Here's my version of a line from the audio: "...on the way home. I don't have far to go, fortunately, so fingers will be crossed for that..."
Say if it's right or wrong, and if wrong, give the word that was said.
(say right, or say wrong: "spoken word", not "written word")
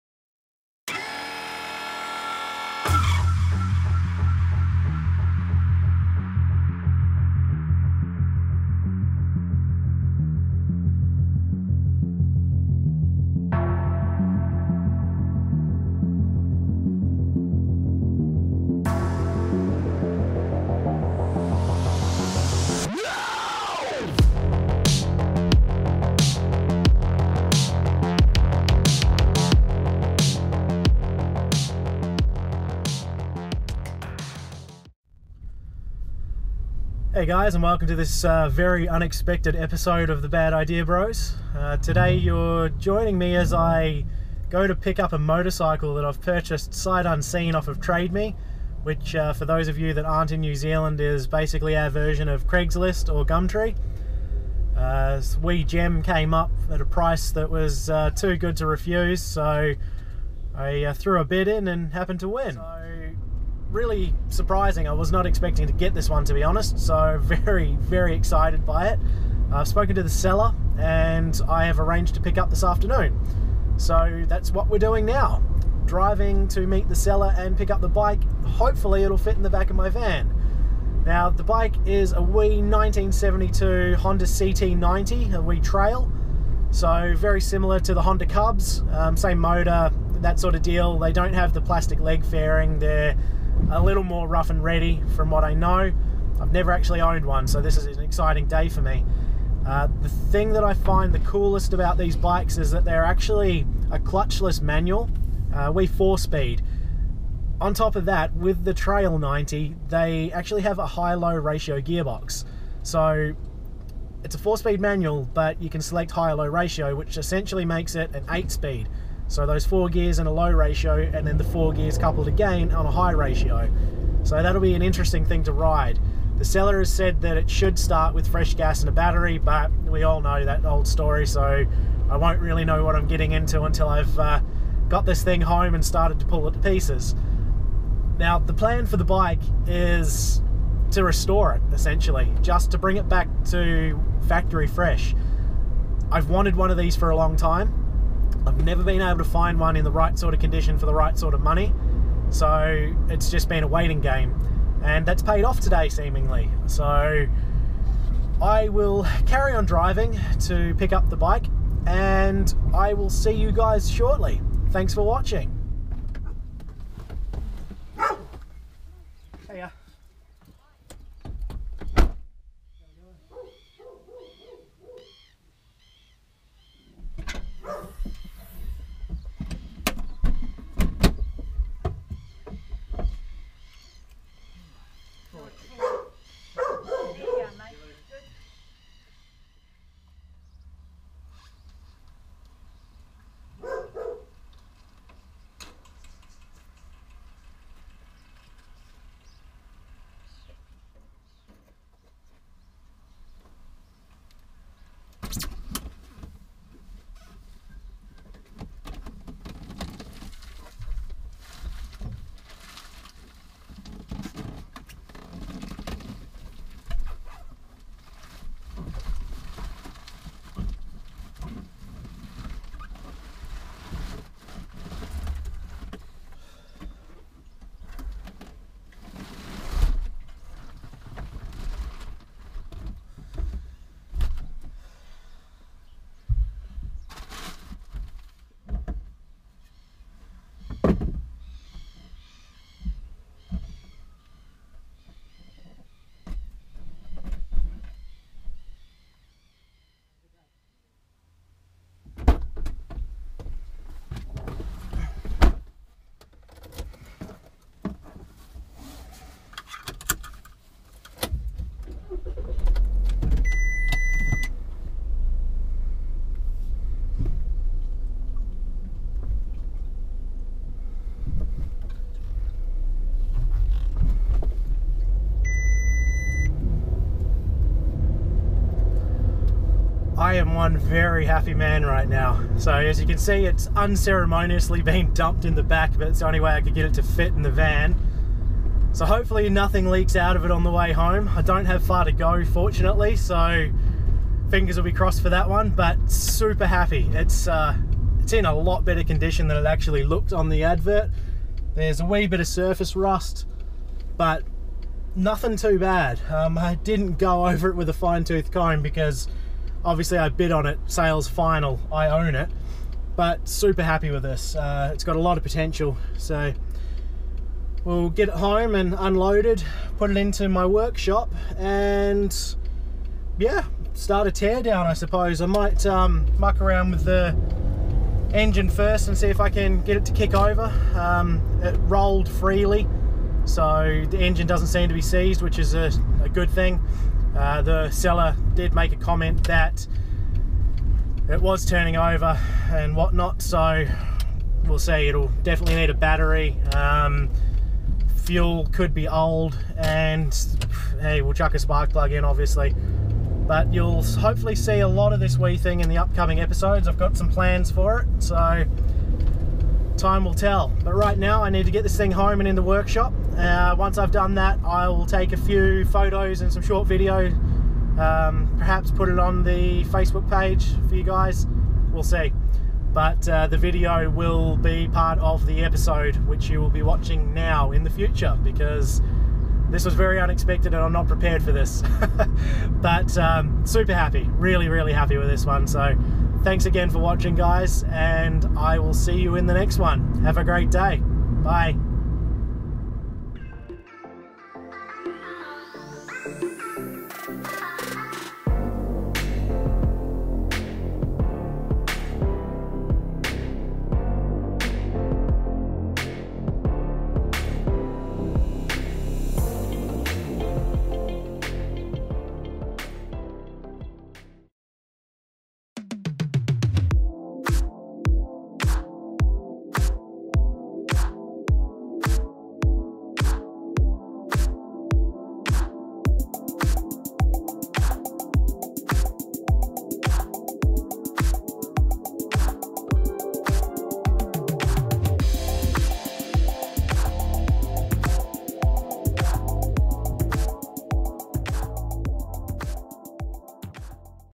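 right.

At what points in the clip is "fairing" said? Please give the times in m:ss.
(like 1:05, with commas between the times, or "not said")
1:32.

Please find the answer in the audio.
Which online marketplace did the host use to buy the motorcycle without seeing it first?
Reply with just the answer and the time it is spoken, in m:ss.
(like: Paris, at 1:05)
TradeMe, at 0:47.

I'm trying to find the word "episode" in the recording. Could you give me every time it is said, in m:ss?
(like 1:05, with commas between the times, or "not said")
0:39, 5:56, 6:15.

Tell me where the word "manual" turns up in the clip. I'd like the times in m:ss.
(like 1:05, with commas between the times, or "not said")
1:44, 1:54.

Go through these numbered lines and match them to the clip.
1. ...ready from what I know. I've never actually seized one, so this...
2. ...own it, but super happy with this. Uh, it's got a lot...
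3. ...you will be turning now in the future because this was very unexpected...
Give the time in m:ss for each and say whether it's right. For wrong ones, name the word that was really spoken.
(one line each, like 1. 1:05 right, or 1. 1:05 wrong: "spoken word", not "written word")
1. 1:34 wrong: "owned", not "seized"
2. 5:12 right
3. 6:16 wrong: "watching", not "turning".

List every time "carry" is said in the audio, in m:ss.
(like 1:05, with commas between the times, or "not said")
2:39.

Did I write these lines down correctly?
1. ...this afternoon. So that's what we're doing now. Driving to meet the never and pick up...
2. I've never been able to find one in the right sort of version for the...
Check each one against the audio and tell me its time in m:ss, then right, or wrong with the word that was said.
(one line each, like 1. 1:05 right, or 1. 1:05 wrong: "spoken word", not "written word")
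1. 1:12 wrong: "seller", not "never"
2. 2:28 wrong: "condition", not "version".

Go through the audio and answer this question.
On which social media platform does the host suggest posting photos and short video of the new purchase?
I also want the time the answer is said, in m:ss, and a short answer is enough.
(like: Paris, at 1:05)
Facebook, at 6:09.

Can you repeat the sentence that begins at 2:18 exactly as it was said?
Now, the plan for the bike is to restore it, essentially, just to bring it back to factory fresh.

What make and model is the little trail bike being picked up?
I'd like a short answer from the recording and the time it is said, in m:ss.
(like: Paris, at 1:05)
Honda CT90, at 1:23.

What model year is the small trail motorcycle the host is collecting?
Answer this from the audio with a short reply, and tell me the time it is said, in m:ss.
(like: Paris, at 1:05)
1972, at 1:22.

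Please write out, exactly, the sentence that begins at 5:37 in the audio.
Uh, the seller did make a comment that it was turning over and whatnot, so we'll see.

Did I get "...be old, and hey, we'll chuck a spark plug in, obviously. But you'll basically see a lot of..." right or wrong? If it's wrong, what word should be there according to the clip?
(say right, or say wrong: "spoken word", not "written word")
wrong: "hopefully", not "basically".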